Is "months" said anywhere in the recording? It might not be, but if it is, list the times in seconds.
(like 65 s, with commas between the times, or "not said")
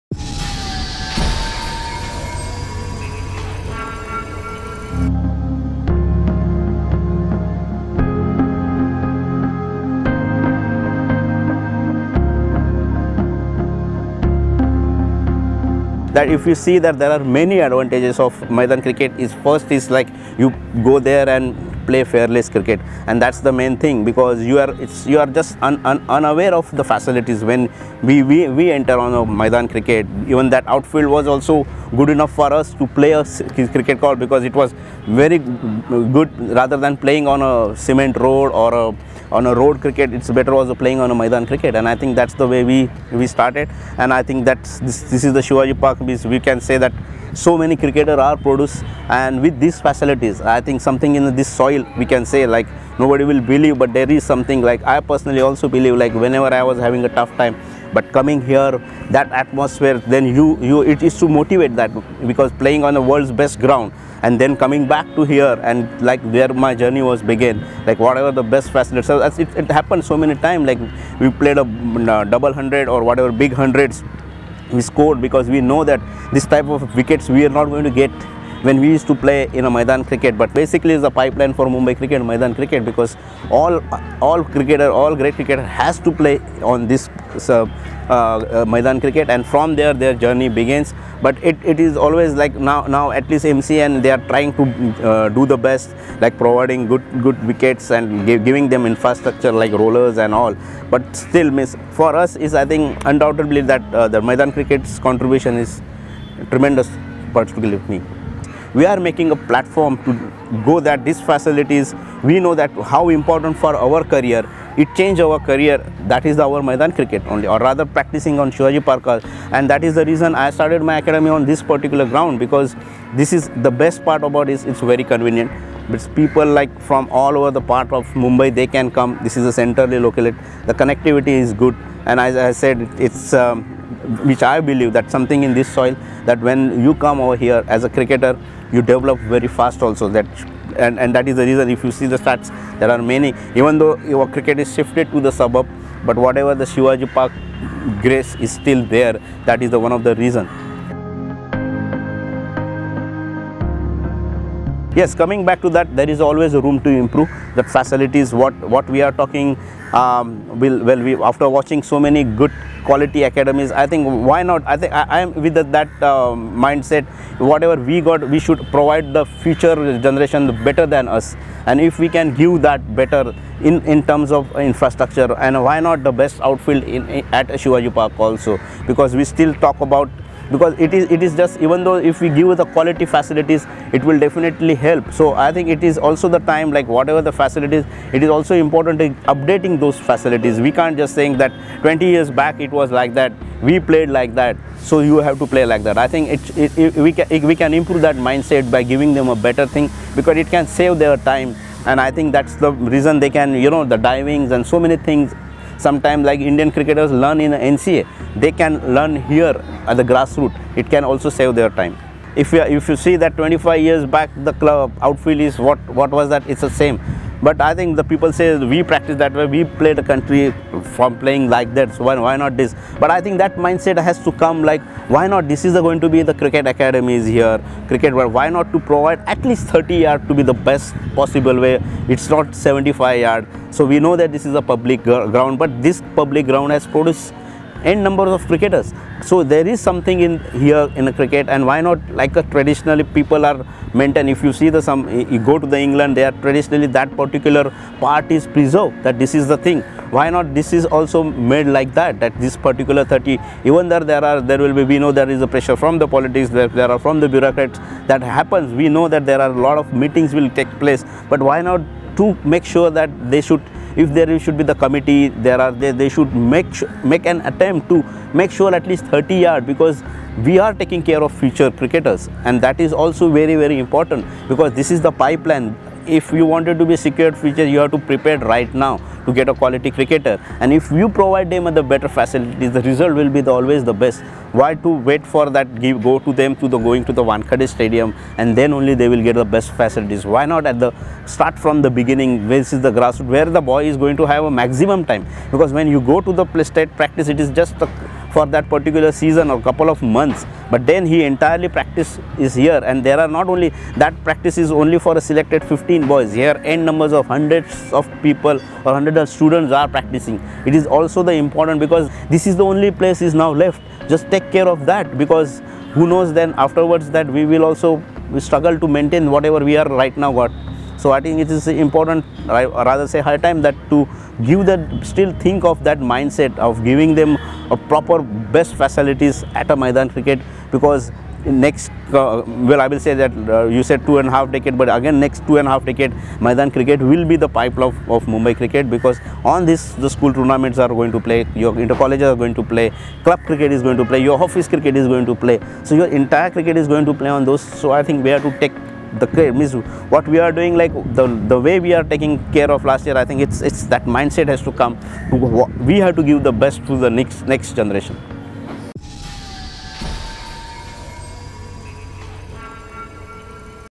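300 s.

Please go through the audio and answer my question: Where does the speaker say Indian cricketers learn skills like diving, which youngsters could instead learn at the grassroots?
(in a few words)
NCA.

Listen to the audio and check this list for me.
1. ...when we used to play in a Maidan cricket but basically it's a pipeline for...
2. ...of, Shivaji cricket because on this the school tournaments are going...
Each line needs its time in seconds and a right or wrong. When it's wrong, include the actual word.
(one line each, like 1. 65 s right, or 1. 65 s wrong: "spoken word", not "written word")
1. 78 s right
2. 338 s wrong: "Mumbai", not "Shivaji".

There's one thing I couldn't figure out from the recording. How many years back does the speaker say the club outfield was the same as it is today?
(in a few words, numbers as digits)
25.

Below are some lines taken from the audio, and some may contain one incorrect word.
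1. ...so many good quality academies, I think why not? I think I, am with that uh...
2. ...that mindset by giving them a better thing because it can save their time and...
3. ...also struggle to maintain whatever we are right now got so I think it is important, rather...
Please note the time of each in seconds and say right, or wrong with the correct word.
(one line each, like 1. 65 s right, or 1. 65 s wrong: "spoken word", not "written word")
1. 161 s right
2. 198 s right
3. 317 s right.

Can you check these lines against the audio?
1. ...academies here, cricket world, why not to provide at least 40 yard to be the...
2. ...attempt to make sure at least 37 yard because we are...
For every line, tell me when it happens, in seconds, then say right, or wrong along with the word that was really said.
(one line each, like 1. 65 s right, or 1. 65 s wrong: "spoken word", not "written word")
1. 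226 s wrong: "30", not "40"
2. 267 s wrong: "30", not "37".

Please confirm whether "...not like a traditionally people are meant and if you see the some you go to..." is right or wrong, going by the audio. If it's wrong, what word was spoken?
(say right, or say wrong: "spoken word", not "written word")
right.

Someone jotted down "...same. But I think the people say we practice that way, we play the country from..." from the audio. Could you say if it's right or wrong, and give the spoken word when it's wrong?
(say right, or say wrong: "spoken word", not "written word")
right.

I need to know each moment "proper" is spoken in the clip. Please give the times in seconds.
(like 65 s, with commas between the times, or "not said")
327 s.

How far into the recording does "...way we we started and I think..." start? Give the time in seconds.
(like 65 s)
42 s.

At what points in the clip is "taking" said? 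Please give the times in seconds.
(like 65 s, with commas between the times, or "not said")
270 s, 352 s.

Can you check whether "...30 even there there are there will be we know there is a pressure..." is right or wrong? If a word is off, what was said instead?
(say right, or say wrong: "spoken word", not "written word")
right.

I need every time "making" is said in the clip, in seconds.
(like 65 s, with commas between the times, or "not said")
109 s.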